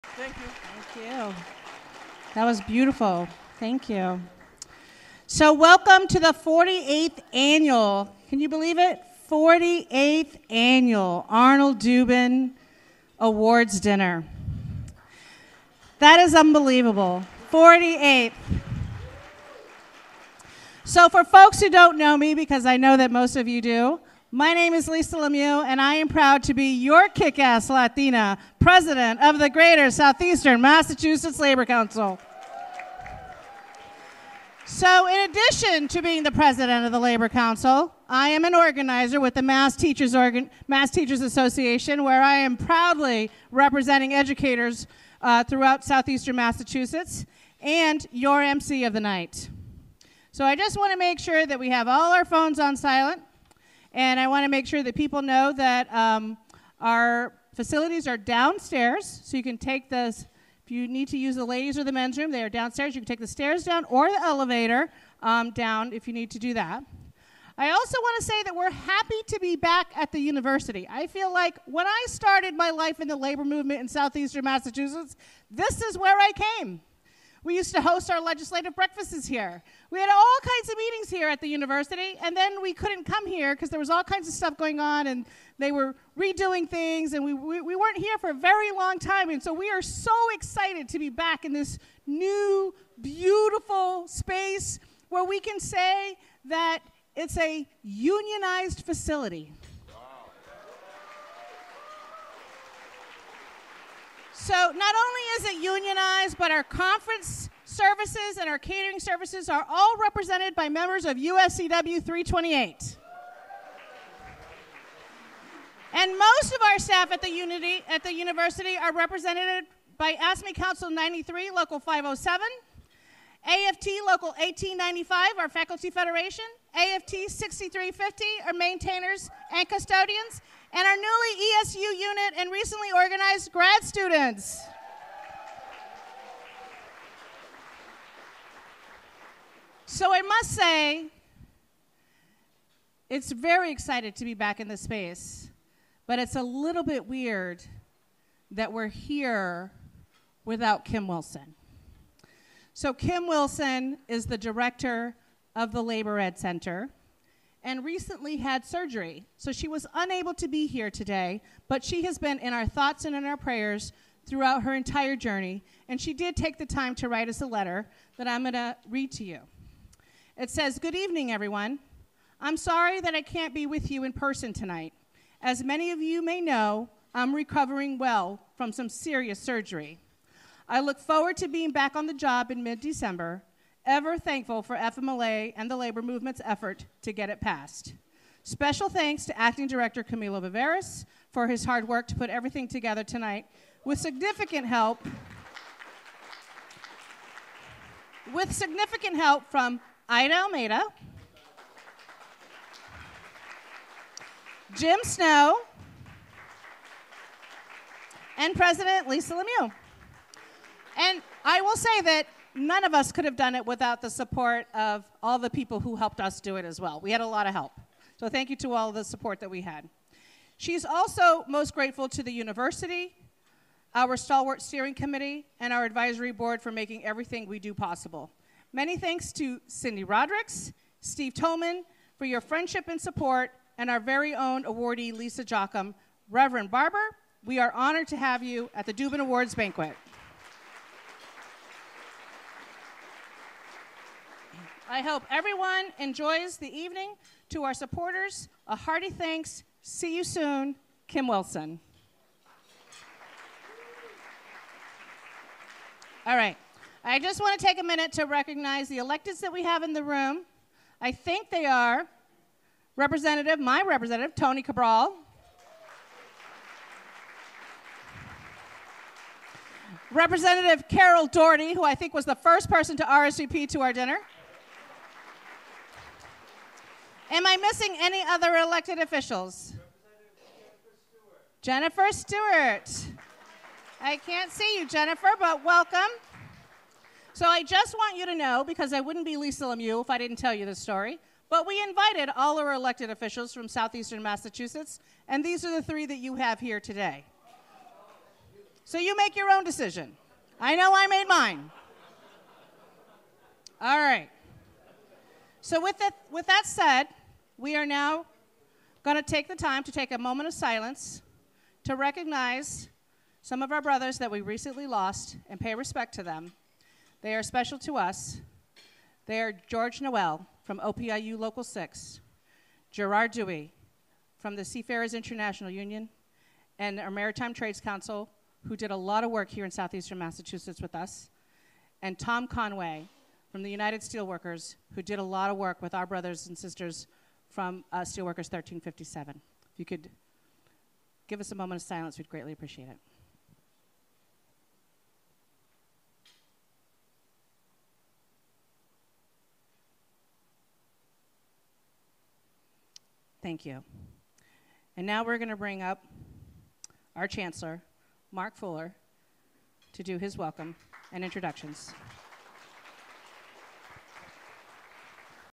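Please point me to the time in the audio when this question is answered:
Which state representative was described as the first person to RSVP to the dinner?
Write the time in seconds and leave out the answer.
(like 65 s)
270 s.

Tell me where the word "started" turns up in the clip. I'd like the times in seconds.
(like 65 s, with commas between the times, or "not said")
72 s.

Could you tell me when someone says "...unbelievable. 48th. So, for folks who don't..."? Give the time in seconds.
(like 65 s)
16 s.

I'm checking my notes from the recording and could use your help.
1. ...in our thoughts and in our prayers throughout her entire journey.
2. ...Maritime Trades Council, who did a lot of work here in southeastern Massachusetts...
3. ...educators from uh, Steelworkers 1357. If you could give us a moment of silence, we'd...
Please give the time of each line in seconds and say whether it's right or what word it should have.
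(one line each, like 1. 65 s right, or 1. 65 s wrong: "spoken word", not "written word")
1. 162 s right
2. 327 s right
3. 336 s wrong: "sisters", not "educators".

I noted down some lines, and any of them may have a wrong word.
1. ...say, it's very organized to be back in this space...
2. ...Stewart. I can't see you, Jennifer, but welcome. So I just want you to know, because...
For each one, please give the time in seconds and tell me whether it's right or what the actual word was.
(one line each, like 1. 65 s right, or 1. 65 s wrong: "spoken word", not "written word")
1. 140 s wrong: "excited", not "organized"
2. 282 s right.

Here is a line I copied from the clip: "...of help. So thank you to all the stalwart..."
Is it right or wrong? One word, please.
wrong.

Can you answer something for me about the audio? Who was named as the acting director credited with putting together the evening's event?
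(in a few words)
Camilo Viveiros.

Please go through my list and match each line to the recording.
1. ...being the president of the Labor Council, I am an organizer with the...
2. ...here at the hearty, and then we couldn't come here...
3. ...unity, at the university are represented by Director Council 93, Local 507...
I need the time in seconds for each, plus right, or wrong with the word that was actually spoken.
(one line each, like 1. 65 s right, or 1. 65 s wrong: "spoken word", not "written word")
1. 36 s right
2. 81 s wrong: "university", not "hearty"
3. 117 s wrong: "AFSCME", not "Director".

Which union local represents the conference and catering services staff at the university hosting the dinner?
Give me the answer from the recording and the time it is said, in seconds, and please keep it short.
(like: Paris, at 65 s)
UFCW 328, at 111 s.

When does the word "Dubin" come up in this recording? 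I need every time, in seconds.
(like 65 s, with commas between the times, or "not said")
11 s, 238 s.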